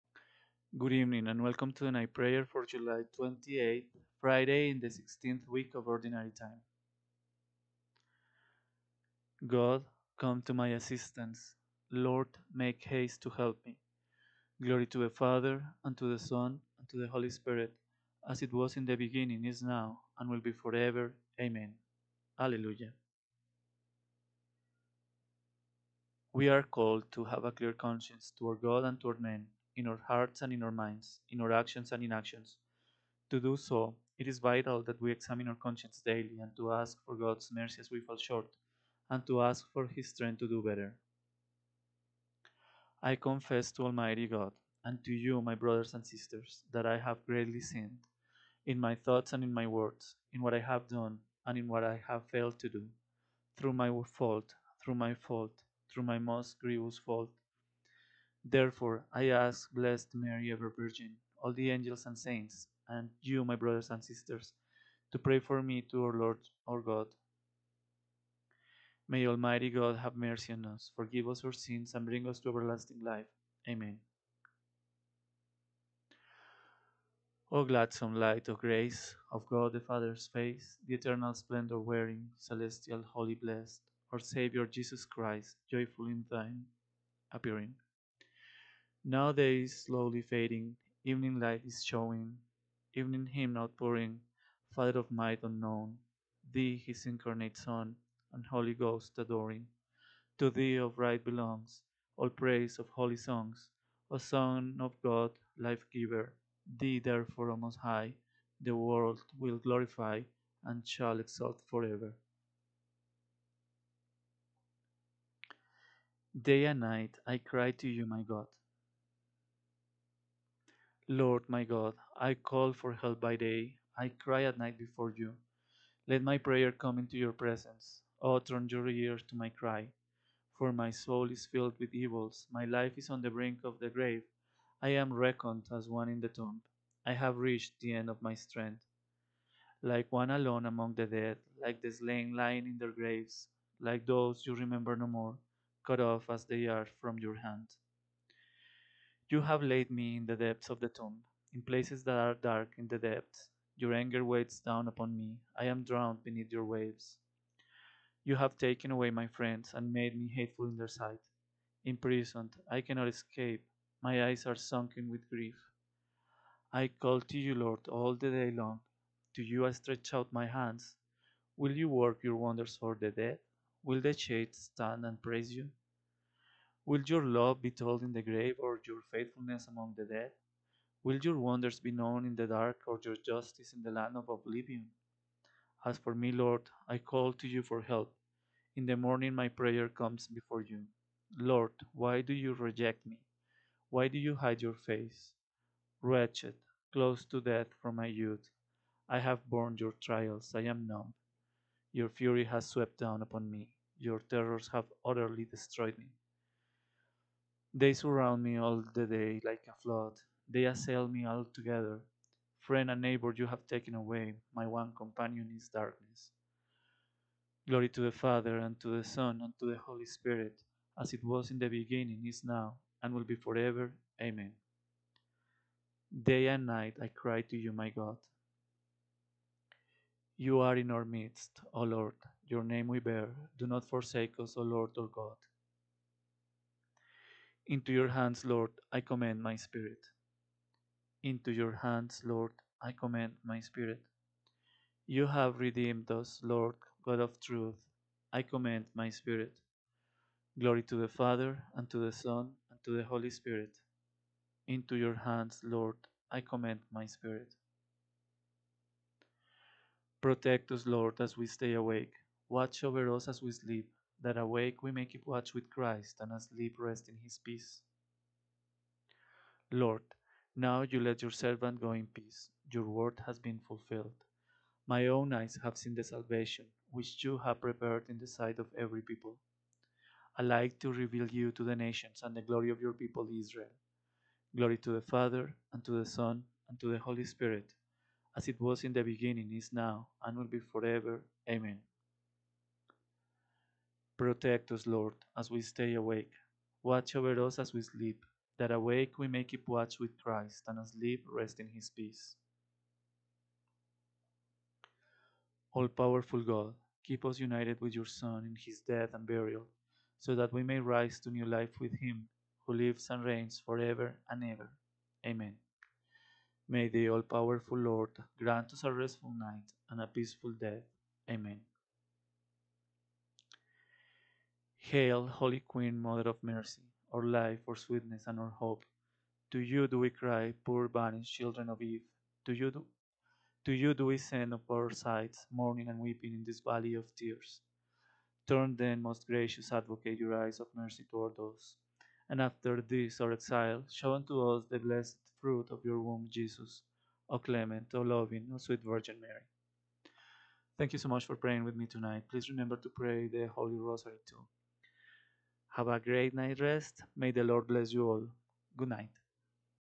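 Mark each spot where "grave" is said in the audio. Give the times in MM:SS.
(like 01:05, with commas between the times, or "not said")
02:13, 02:22, 02:58.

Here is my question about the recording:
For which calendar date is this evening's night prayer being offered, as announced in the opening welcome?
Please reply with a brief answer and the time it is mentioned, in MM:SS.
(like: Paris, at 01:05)
July 28th, at 00:02.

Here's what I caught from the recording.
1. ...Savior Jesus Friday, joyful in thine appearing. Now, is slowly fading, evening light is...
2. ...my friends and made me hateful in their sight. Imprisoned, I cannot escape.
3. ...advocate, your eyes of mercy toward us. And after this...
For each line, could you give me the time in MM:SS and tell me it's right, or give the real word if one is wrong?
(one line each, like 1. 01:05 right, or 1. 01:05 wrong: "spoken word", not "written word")
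1. 01:24 wrong: "Christ", not "Friday"
2. 02:39 right
3. 05:39 right.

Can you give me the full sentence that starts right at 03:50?
You are in our midst, O Lord.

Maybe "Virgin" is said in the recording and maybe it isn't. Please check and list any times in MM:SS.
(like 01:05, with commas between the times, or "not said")
01:00, 05:48.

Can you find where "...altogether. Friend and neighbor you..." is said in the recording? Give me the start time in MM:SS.
03:31.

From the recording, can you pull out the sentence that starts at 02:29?
You have laid me in the depths of the tomb, in places that are dark in the depths.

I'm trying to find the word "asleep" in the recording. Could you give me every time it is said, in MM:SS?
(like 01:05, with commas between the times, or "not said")
04:26, 05:00.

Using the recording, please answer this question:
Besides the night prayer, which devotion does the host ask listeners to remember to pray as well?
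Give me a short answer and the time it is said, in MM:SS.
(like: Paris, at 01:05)
the Holy Rosary, at 05:53.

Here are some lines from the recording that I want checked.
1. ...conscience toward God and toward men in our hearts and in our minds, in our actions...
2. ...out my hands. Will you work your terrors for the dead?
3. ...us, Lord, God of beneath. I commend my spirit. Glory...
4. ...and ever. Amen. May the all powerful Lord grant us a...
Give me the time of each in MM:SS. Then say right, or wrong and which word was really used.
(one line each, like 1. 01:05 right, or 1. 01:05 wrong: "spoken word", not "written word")
1. 00:27 right
2. 02:50 wrong: "wonders", not "terrors"
3. 04:06 wrong: "truth", not "beneath"
4. 05:14 right.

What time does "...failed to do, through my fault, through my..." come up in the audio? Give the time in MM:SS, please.
00:52.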